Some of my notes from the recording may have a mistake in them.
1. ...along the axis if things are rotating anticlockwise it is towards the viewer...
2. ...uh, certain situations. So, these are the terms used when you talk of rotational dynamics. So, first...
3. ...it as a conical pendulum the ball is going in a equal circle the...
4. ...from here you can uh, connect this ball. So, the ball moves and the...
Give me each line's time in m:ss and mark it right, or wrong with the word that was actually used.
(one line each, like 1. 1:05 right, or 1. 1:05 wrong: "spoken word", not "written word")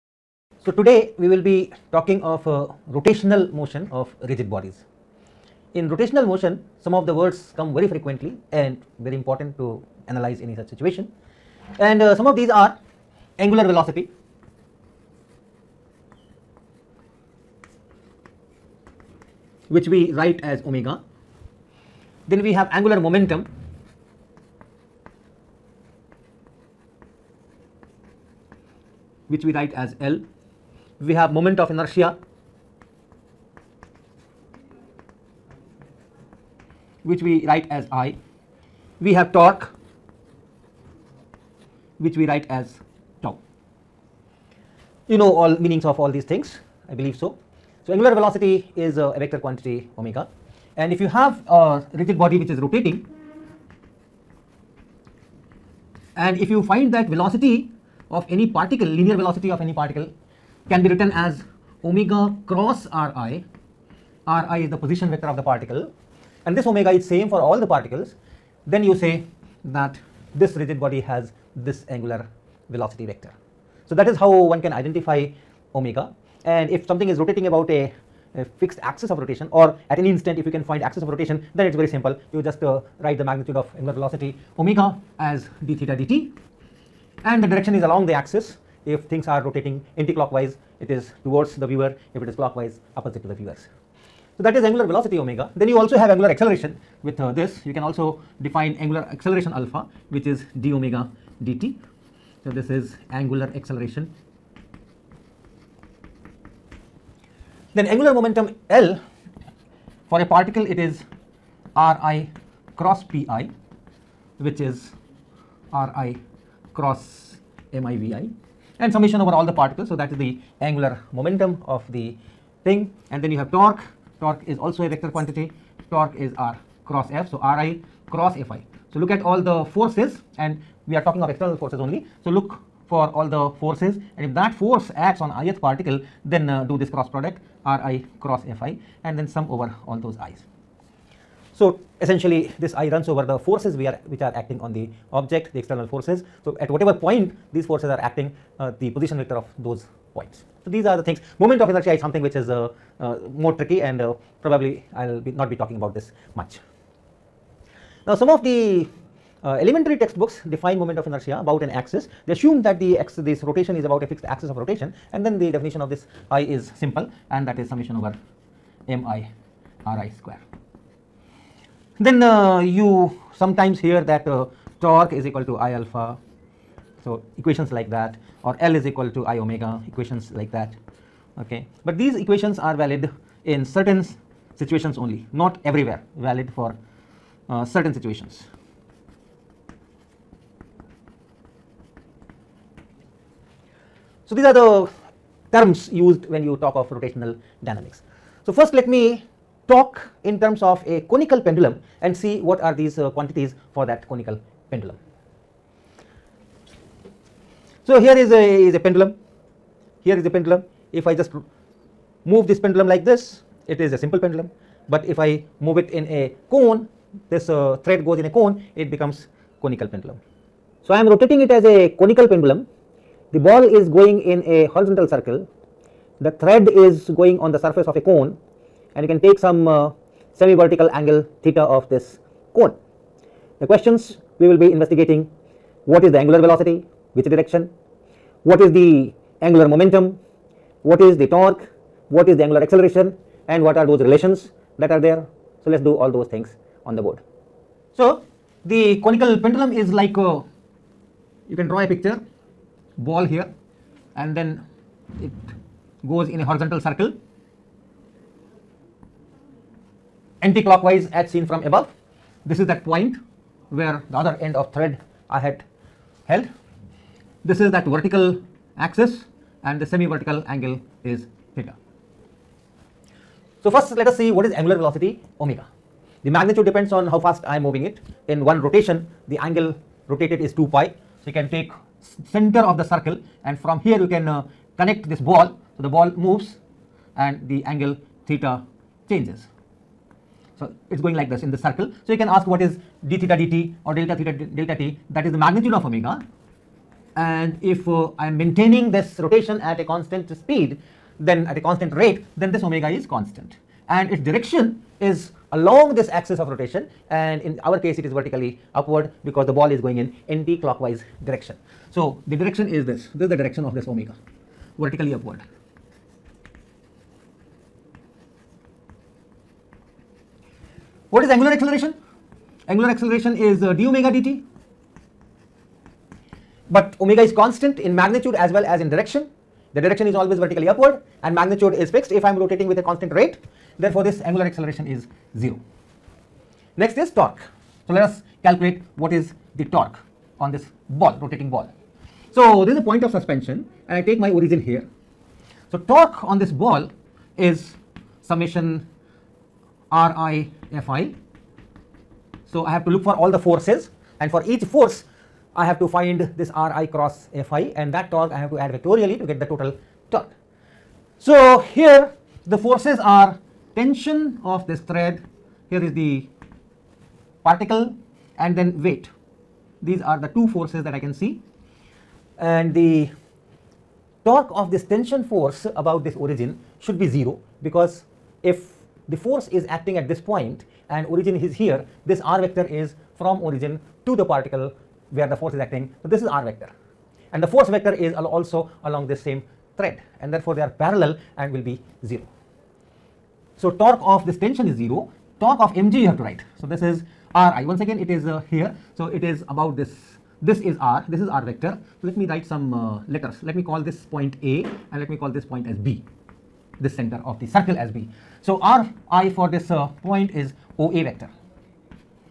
1. 1:27 right
2. 3:07 right
3. 3:41 wrong: "horizontal", not "equal"
4. 4:43 right.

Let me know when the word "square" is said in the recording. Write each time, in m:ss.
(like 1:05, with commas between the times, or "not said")
2:50.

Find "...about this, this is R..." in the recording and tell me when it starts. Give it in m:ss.
6:39.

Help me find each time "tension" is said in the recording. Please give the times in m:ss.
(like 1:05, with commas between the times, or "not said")
6:03, 6:14, 6:34.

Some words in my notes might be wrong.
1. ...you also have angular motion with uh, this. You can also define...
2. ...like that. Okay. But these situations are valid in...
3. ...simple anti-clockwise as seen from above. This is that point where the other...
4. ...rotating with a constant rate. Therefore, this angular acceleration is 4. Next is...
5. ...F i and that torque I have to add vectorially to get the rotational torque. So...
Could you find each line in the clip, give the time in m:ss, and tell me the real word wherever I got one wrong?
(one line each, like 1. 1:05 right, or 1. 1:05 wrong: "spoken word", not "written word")
1. 1:35 wrong: "acceleration", not "motion"
2. 3:00 wrong: "equations", not "situations"
3. 4:16 wrong: "circle", not "simple"
4. 5:32 wrong: "0", not "4"
5. 5:57 wrong: "total", not "rotational".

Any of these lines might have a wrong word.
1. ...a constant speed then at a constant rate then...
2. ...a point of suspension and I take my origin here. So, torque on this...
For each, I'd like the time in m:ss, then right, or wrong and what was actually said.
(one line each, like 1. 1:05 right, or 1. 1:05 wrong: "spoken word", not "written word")
1. 4:59 right
2. 5:42 right.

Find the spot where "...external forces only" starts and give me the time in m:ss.
2:11.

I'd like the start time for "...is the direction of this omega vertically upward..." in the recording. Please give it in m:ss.
5:13.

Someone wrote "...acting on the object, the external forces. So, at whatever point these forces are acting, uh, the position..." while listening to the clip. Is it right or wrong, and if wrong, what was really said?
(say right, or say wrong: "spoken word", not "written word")
right.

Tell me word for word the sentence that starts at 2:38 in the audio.
Now, some of the uh, elementary textbooks define moment of inertia about an axis.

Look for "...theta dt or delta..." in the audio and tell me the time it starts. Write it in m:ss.
4:53.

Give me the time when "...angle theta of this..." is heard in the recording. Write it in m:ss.
3:50.